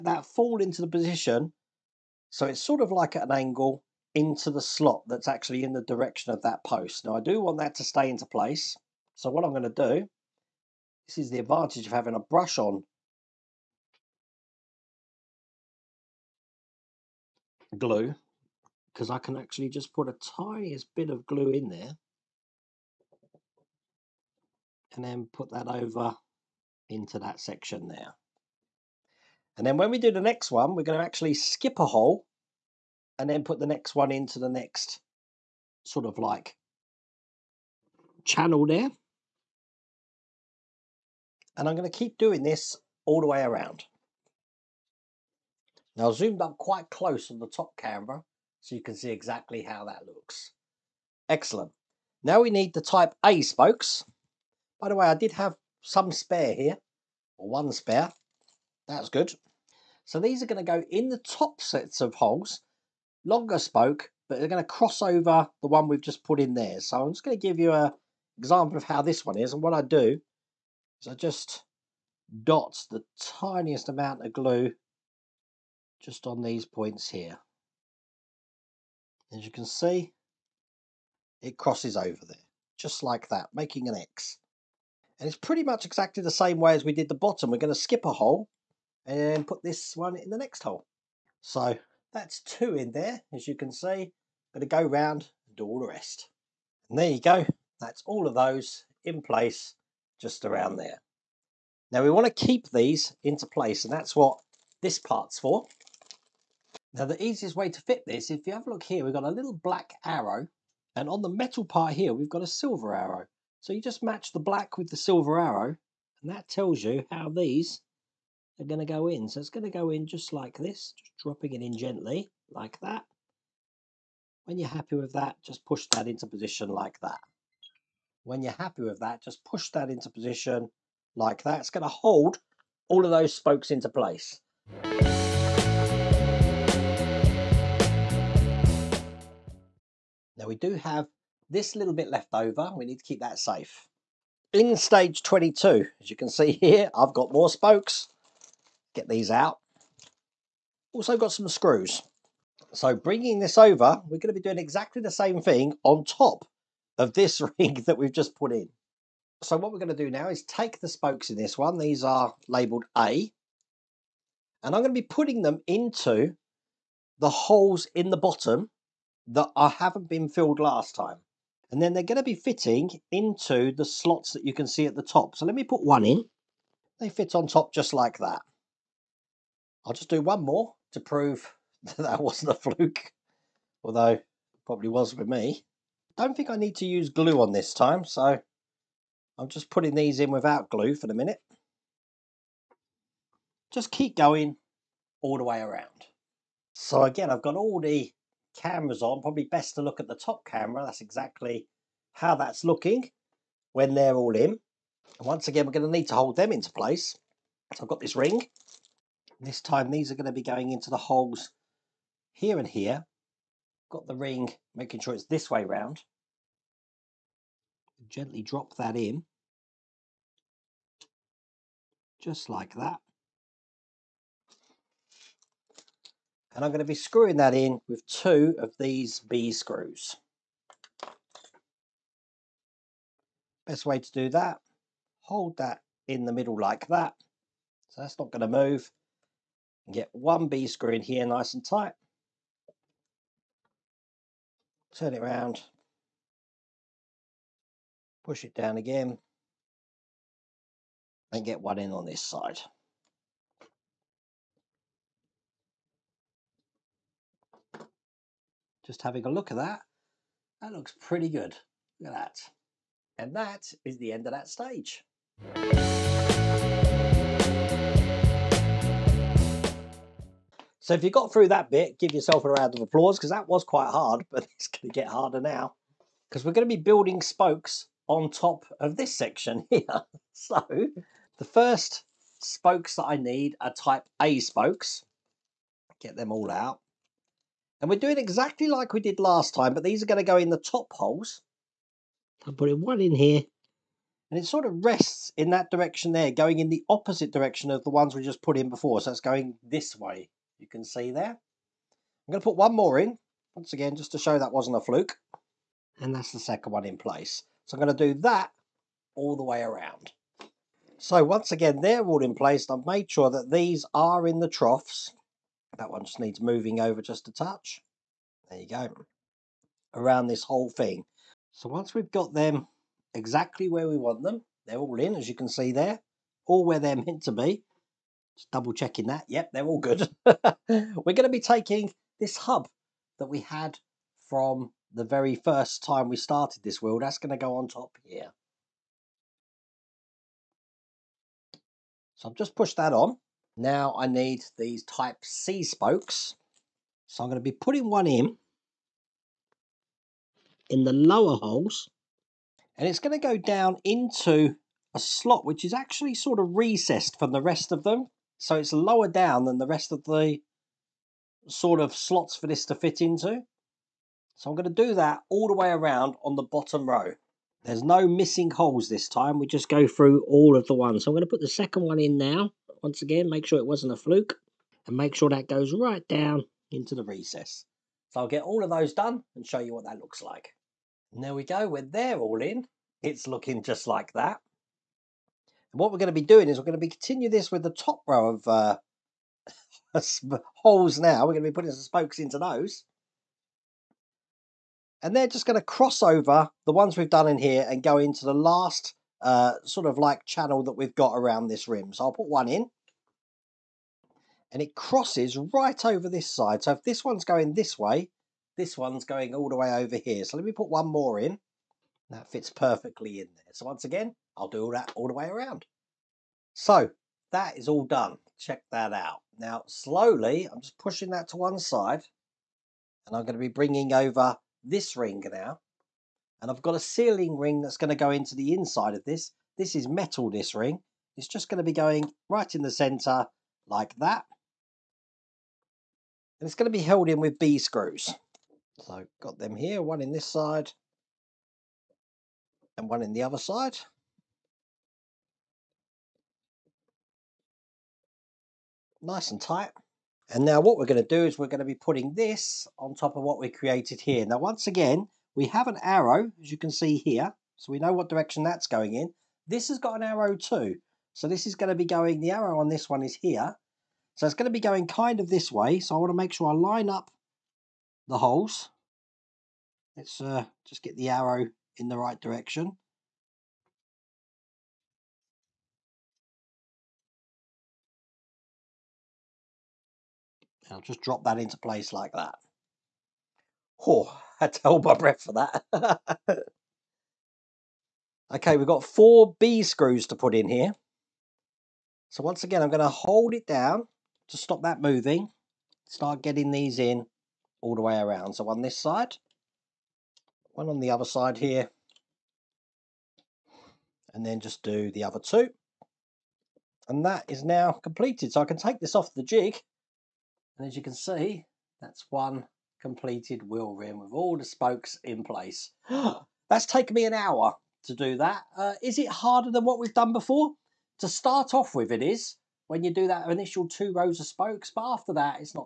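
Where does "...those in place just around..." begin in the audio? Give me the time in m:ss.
1:38.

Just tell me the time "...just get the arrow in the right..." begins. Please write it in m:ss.
7:50.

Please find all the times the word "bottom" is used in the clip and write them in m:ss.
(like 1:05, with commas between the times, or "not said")
1:27, 2:48, 6:06.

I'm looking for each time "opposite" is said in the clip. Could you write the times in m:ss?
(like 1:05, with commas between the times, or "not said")
4:56.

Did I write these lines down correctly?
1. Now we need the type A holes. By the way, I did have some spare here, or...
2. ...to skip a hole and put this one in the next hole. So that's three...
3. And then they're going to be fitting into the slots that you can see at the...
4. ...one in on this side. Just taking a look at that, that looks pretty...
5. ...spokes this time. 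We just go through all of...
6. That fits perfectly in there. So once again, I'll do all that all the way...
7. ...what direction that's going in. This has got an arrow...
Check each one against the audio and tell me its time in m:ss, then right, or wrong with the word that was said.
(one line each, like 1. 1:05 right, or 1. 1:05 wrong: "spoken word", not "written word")
1. 0:52 wrong: "spokes", not "holes"
2. 1:27 wrong: "two", not "three"
3. 2:51 right
4. 4:11 wrong: "having", not "taking"
5. 6:08 wrong: "holes", not "spokes"
6. 6:52 right
7. 7:37 right.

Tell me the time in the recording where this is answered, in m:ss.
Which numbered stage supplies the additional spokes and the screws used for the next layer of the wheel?
2:24.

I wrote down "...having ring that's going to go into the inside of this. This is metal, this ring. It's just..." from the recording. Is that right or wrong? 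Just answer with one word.
wrong.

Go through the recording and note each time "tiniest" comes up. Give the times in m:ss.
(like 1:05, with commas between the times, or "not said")
0:20, 1:13.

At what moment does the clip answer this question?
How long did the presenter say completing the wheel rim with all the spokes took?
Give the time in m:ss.
8:37.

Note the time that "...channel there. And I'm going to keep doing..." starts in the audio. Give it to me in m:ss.
0:38.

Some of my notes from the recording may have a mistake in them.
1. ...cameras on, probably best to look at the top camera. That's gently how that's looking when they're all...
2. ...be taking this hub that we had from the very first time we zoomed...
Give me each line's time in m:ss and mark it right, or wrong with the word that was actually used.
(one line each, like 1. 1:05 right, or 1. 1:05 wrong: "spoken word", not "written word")
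1. 3:18 wrong: "exactly", not "gently"
2. 5:31 wrong: "started", not "zoomed".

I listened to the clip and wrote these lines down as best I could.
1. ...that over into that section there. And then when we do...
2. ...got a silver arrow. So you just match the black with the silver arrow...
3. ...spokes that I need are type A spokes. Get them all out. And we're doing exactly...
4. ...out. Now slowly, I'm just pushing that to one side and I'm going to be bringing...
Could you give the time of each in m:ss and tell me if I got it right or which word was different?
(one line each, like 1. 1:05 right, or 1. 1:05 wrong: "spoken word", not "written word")
1. 0:25 right
2. 1:52 right
3. 4:42 right
4. 6:58 right.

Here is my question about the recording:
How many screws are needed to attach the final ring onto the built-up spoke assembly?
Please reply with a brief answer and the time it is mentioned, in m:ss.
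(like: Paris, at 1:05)
4, at 8:08.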